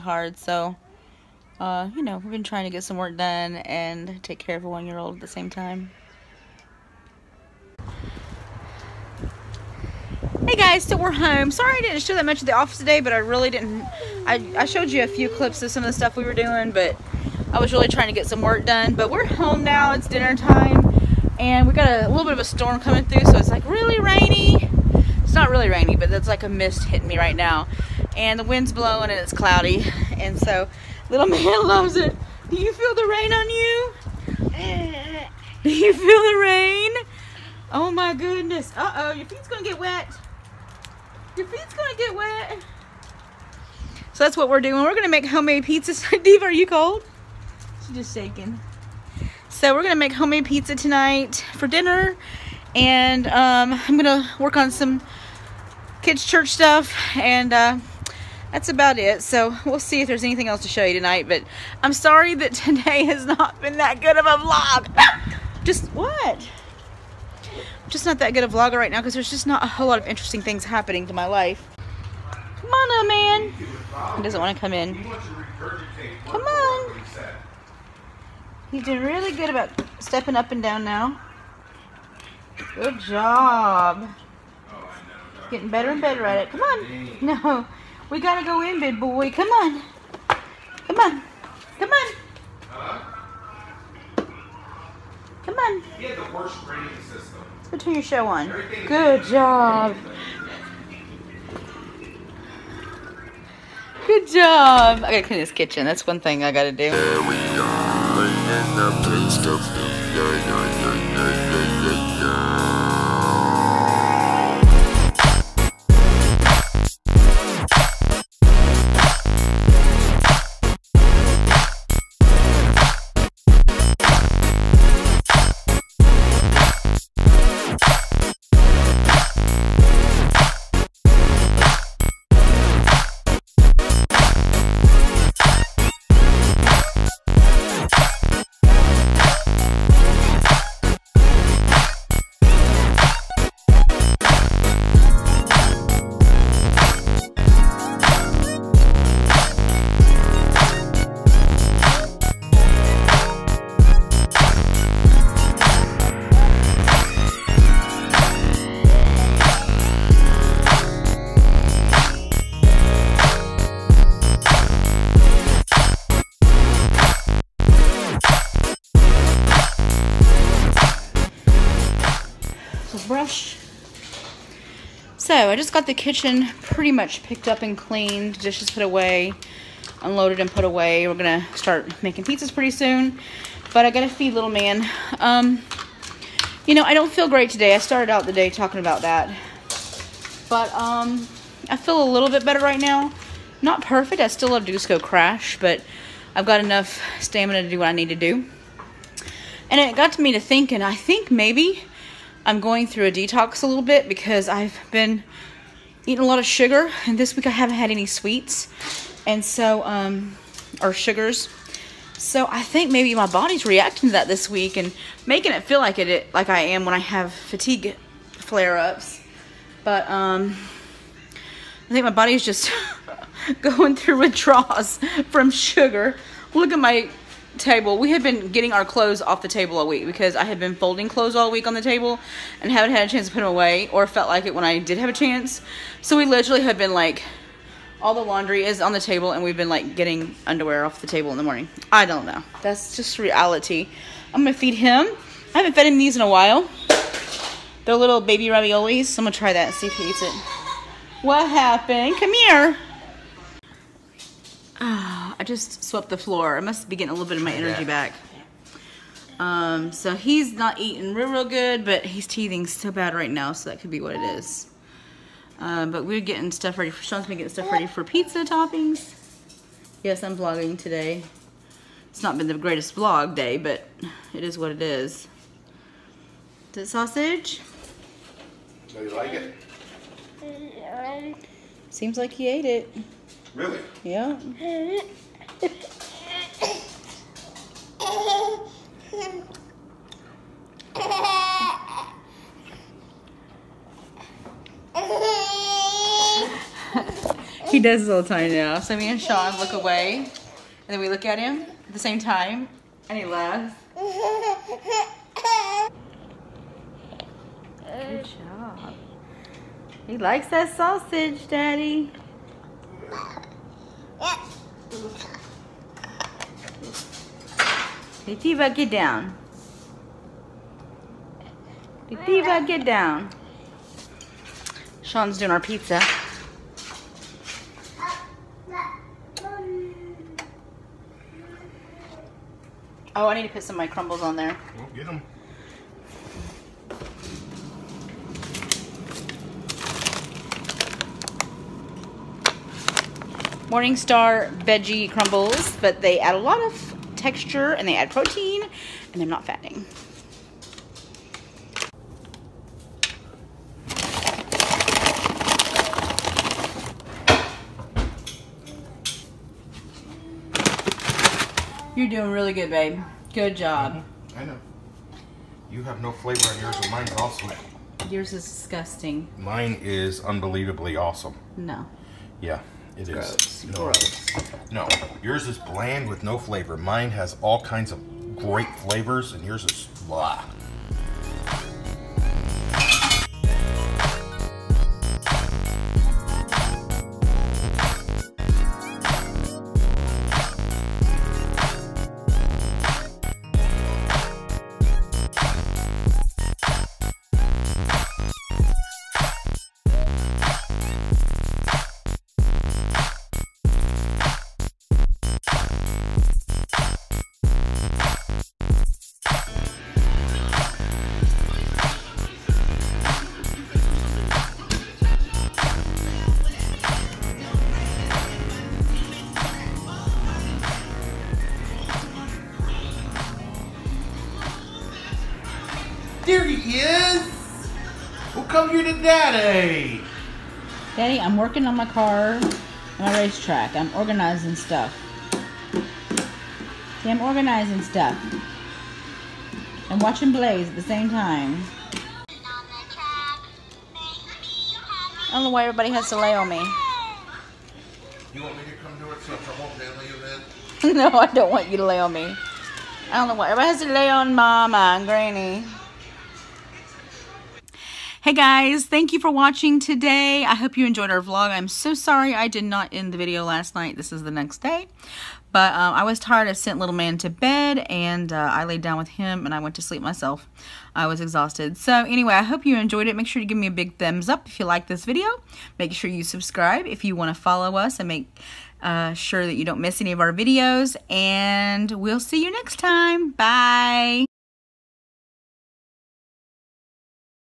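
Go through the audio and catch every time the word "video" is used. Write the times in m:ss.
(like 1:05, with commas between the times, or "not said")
7:43, 7:55, 8:00.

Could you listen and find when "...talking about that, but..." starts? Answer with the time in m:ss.
3:08.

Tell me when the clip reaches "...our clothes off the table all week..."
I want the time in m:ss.
3:48.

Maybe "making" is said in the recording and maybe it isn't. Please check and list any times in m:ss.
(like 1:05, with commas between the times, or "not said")
3:02, 3:35.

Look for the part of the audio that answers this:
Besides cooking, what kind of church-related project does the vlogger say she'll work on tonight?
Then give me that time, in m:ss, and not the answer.
0:56.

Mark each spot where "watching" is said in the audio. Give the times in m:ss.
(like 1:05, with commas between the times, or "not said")
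7:19, 7:39.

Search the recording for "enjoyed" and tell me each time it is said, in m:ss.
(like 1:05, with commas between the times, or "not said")
7:40, 7:52.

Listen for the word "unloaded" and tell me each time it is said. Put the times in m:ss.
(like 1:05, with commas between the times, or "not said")
3:00.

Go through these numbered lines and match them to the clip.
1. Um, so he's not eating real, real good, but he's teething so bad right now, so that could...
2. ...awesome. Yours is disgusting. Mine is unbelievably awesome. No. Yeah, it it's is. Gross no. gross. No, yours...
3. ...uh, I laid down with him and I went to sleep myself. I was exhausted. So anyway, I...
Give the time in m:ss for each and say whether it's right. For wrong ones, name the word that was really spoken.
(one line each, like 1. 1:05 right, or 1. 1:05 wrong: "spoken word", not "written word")
1. 4:19 right
2. 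6:07 right
3. 7:48 right.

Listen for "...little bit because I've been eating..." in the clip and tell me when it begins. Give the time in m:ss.
3:23.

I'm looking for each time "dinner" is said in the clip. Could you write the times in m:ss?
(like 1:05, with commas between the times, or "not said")
0:20, 0:51.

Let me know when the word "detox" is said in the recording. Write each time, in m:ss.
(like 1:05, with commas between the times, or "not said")
3:23.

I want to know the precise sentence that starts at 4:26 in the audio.
For, Sean's been getting stuff ready for pizza toppings.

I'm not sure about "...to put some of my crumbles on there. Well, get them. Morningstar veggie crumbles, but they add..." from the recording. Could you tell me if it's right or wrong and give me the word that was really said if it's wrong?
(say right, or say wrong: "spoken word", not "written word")
right.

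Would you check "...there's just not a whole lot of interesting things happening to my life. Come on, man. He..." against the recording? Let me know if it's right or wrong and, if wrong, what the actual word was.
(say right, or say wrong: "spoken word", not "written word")
right.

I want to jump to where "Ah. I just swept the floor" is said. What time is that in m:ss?
4:14.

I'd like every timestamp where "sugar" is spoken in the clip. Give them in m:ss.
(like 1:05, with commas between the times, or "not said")
3:26, 3:30, 3:45.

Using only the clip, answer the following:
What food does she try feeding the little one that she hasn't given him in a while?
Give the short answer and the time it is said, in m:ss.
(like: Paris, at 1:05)
Baby raviolis, at 4:08.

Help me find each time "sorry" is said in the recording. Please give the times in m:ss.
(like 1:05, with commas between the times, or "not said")
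0:11, 1:01, 7:41.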